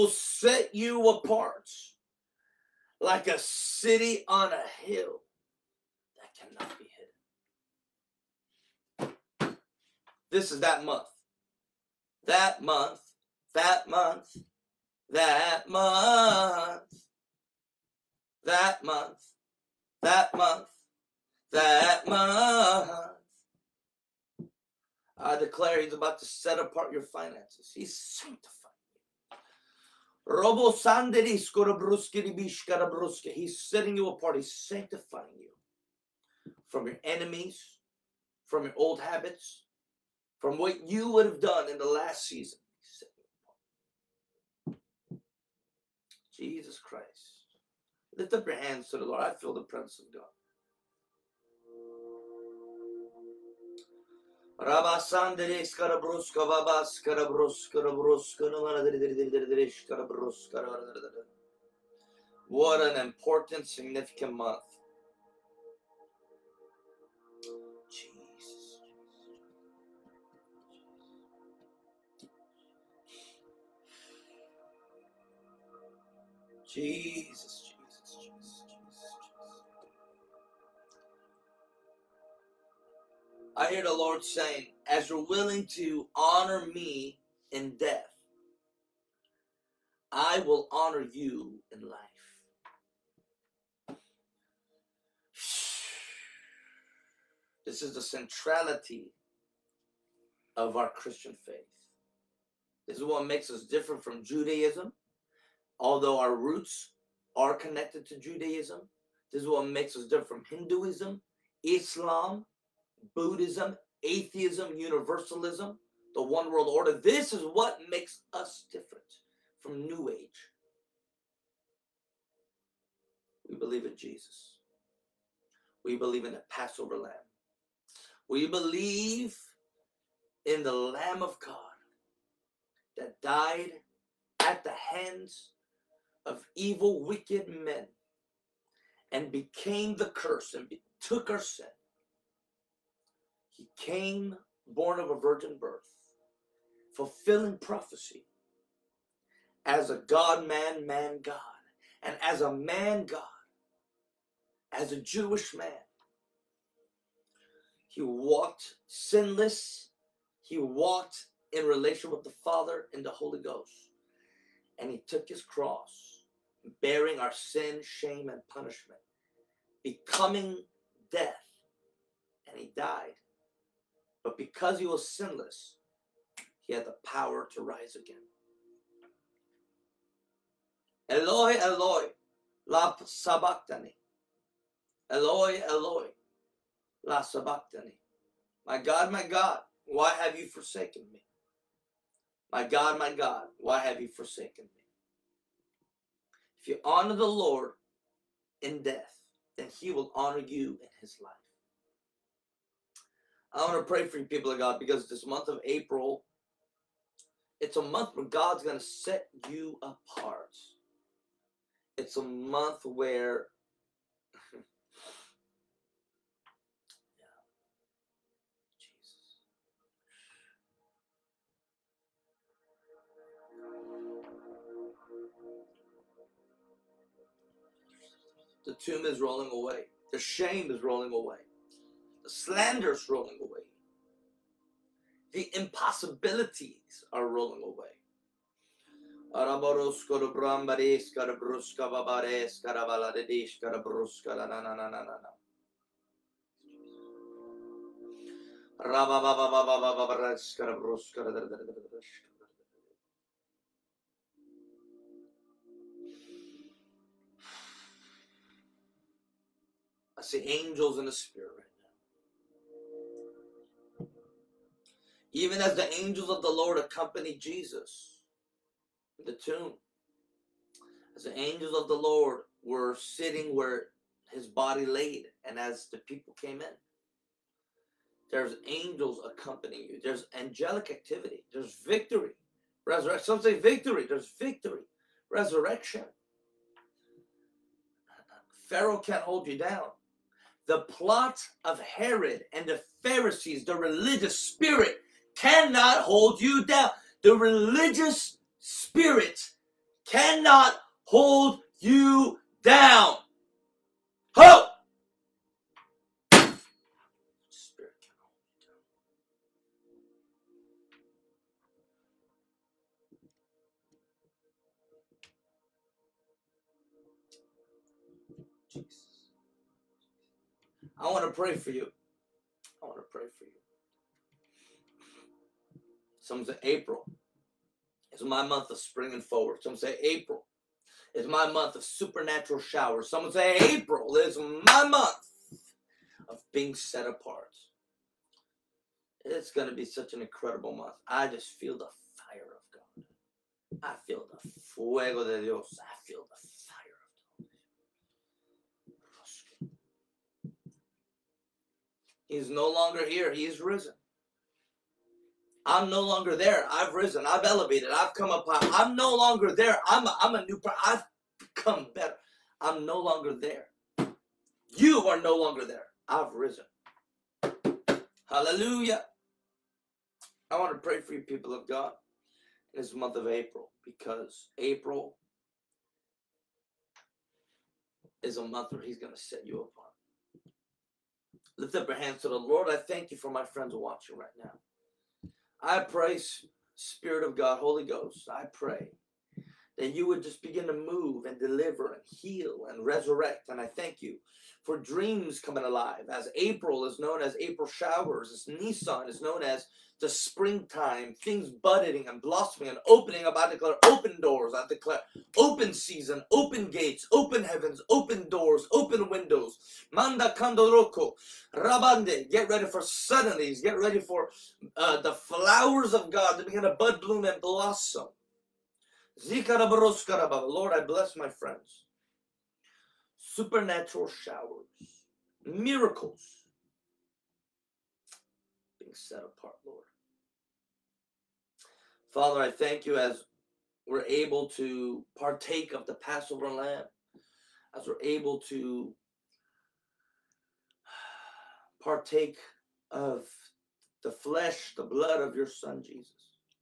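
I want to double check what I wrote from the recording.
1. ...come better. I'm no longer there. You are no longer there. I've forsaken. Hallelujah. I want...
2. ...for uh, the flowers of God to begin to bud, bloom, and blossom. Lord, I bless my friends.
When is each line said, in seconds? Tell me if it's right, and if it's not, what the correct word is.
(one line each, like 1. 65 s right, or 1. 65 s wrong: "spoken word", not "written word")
1. 361 s wrong: "risen", not "forsaken"
2. 413 s right.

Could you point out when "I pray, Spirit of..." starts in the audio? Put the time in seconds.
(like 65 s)
385 s.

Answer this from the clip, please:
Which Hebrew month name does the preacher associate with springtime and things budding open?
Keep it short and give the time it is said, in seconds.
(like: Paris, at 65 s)
Nissan, at 398 s.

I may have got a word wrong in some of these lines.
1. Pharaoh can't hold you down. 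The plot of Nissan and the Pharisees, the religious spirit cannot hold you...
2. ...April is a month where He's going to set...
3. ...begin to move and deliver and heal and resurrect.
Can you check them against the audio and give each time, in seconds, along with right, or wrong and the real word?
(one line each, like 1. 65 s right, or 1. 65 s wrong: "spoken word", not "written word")
1. 288 s wrong: "Herod", not "Nissan"
2. 374 s right
3. 390 s right.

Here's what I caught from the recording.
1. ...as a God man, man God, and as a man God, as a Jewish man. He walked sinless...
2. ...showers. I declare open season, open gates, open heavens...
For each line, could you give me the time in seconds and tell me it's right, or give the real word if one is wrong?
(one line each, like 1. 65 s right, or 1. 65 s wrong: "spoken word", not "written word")
1. 149 s right
2. 404 s wrong: "doors", not "showers".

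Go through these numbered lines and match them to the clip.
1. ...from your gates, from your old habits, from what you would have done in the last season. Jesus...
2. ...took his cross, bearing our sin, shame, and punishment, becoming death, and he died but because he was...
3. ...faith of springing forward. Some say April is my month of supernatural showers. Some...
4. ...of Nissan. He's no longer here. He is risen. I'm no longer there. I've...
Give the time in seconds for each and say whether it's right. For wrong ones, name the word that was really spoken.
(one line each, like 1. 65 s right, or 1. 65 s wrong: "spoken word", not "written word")
1. 36 s wrong: "enemies", not "gates"
2. 165 s right
3. 328 s wrong: "month", not "faith"
4. 350 s wrong: "God", not "Nissan".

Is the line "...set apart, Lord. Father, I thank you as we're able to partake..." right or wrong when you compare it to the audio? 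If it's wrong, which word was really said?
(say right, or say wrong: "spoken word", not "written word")
right.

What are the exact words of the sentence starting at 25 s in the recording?
I declare he's about to set apart your finances.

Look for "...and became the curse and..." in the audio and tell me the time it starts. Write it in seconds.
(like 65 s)
139 s.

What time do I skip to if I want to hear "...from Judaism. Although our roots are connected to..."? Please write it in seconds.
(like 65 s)
104 s.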